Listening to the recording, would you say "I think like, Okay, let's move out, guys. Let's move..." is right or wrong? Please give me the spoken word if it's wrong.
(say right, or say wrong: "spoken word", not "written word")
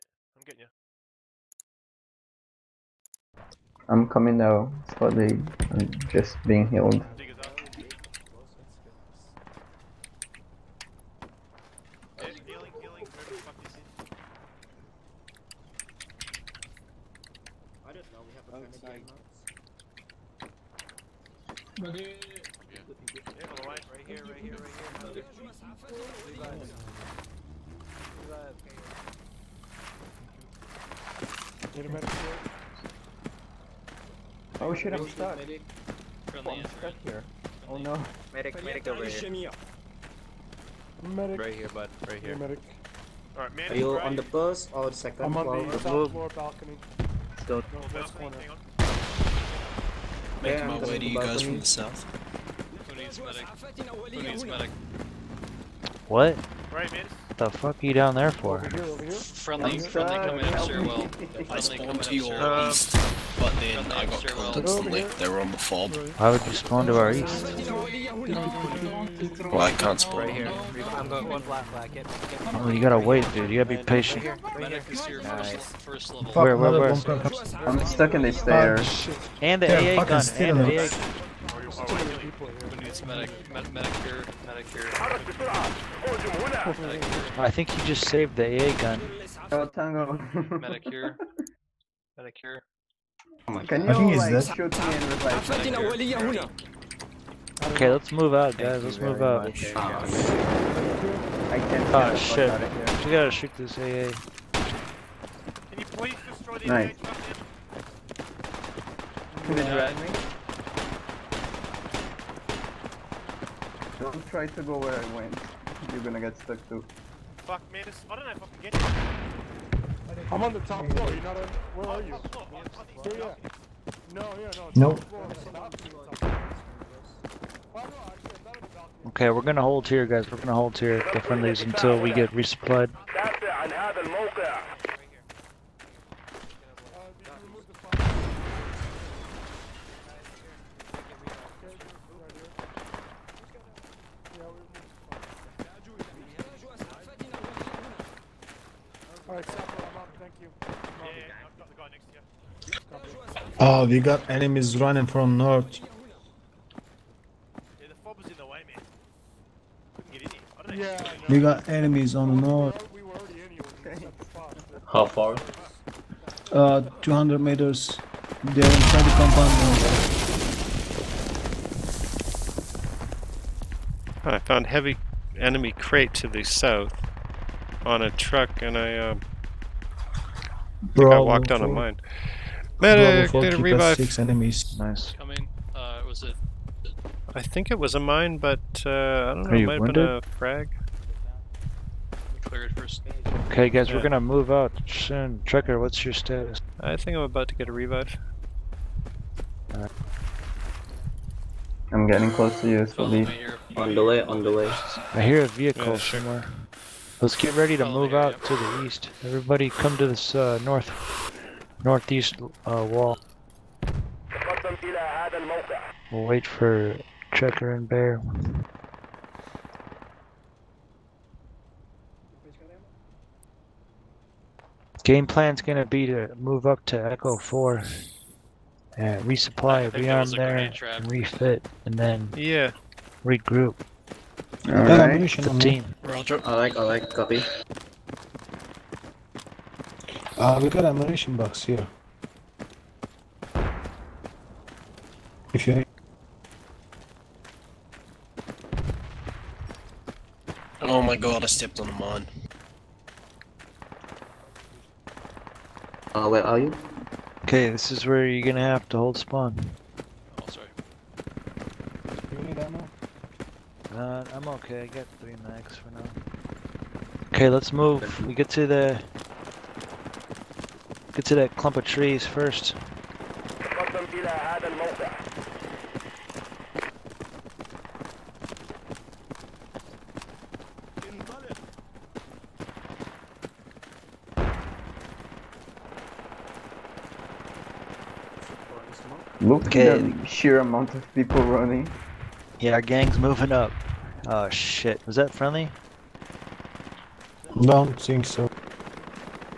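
right.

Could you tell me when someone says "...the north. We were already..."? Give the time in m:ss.
2:42.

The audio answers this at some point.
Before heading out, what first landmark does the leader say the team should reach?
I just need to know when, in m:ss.
4:31.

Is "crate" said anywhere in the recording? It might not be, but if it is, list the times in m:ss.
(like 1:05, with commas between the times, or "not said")
2:55.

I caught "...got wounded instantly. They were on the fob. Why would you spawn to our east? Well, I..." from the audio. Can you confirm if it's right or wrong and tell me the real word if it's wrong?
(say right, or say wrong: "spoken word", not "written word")
wrong: "killed", not "wounded".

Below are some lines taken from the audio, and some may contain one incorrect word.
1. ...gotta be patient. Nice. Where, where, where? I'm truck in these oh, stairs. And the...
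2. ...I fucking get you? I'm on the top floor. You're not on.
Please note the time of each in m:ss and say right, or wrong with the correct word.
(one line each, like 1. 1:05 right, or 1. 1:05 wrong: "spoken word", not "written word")
1. 1:13 wrong: "stuck", not "truck"
2. 1:58 right.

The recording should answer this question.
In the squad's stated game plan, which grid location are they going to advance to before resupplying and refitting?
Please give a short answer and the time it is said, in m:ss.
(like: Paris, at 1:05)
Echo 4, at 3:47.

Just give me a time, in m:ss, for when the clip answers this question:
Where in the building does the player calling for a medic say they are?
0:45.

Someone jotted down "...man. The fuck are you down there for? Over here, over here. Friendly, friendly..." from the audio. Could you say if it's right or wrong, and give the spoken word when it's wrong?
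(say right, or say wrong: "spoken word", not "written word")
right.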